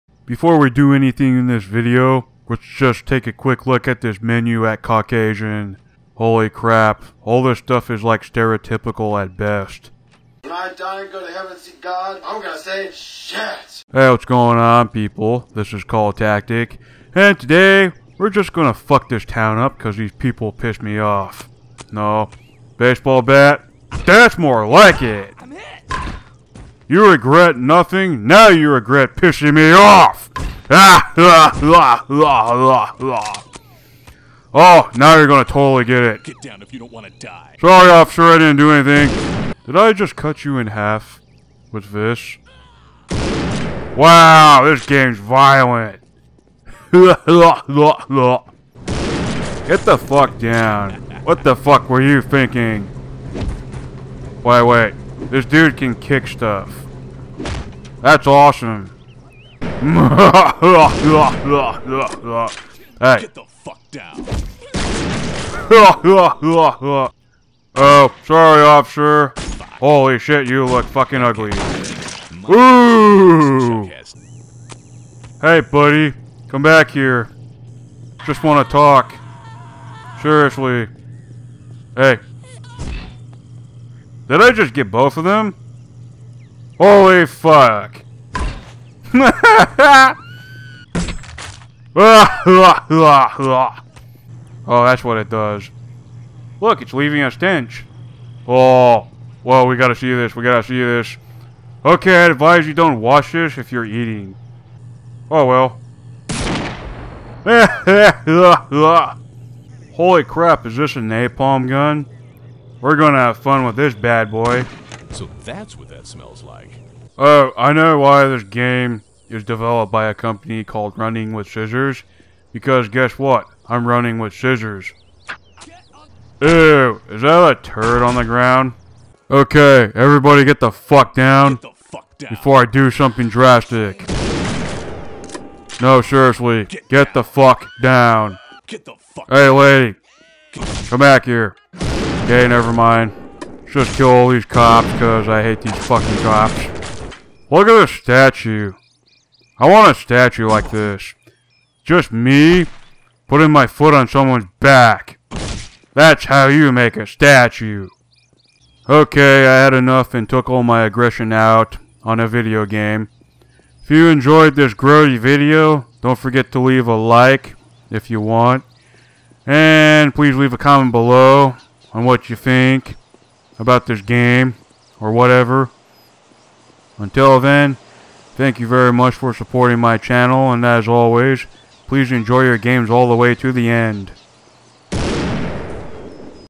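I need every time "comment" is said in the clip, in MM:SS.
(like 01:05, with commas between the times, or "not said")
02:50.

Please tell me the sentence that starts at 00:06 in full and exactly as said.
Holy crap, all this stuff is like stereotypical at best.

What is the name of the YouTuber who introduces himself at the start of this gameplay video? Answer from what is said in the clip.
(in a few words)
Coltactic.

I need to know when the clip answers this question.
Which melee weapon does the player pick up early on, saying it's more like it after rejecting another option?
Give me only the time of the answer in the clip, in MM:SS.
00:22.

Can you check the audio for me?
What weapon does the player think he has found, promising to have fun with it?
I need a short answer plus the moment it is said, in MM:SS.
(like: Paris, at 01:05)
Napalm gun, at 01:50.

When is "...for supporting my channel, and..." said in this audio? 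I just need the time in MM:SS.
02:59.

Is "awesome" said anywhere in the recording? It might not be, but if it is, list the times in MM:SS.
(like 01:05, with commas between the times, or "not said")
00:58.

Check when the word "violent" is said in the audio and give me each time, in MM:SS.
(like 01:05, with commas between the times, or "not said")
00:45.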